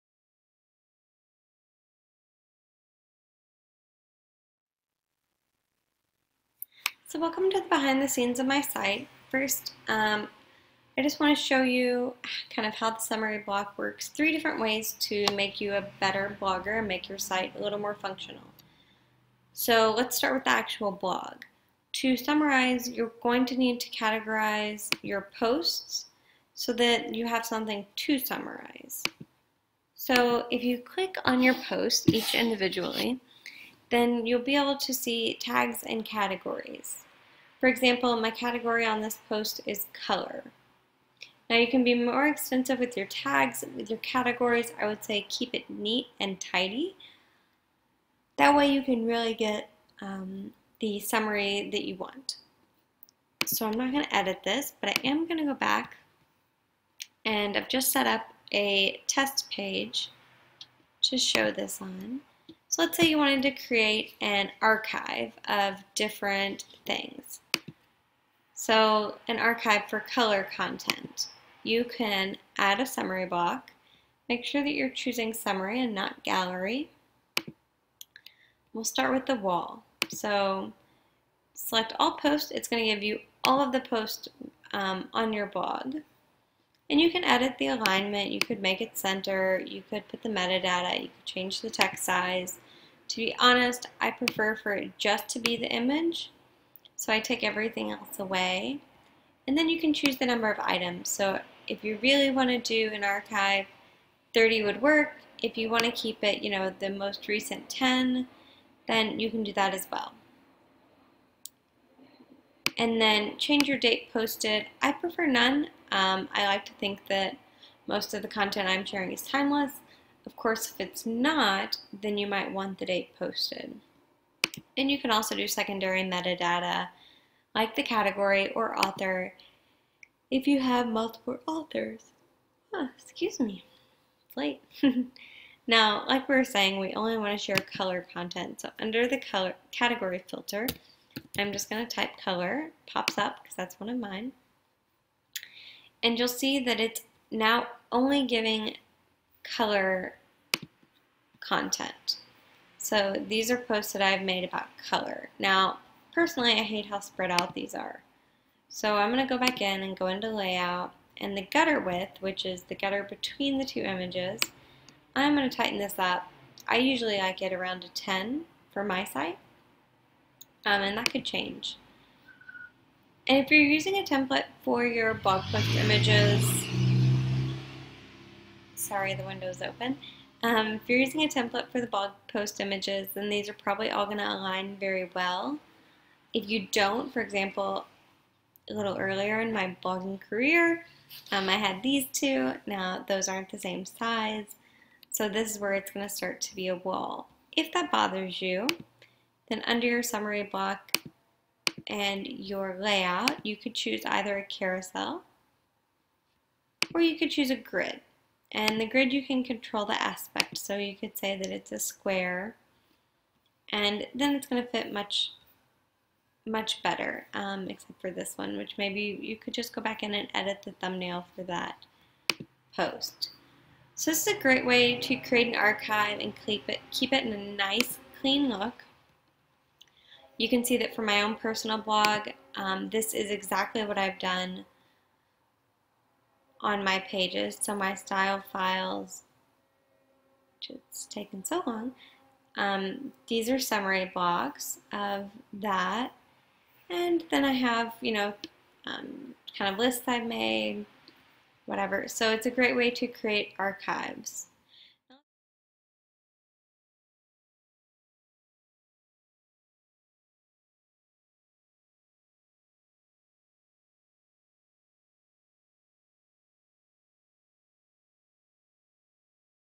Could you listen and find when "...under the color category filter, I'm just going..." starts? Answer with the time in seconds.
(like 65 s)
138 s.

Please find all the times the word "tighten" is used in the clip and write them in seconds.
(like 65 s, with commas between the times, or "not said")
165 s.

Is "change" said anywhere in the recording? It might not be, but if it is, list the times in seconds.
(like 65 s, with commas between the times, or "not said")
91 s, 113 s, 171 s.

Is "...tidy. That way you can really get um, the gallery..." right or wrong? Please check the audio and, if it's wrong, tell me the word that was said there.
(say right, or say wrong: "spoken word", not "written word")
wrong: "summary", not "gallery".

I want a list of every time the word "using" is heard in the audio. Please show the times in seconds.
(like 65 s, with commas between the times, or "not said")
173 s, 180 s.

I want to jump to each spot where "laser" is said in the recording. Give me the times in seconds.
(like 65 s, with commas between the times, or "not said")
not said.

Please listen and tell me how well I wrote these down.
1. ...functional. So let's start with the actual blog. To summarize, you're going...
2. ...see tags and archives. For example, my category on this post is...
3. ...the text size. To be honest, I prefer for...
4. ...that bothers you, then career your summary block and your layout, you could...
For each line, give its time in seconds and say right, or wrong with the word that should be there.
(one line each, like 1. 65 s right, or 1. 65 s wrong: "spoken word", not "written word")
1. 17 s right
2. 34 s wrong: "categories", not "archives"
3. 91 s right
4. 197 s wrong: "under", not "career".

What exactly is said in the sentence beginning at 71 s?
You can add a summary block.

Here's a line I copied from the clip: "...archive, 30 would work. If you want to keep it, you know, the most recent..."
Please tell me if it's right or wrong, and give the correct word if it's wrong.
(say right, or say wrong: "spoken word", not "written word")
right.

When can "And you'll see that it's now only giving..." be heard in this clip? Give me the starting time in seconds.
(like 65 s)
146 s.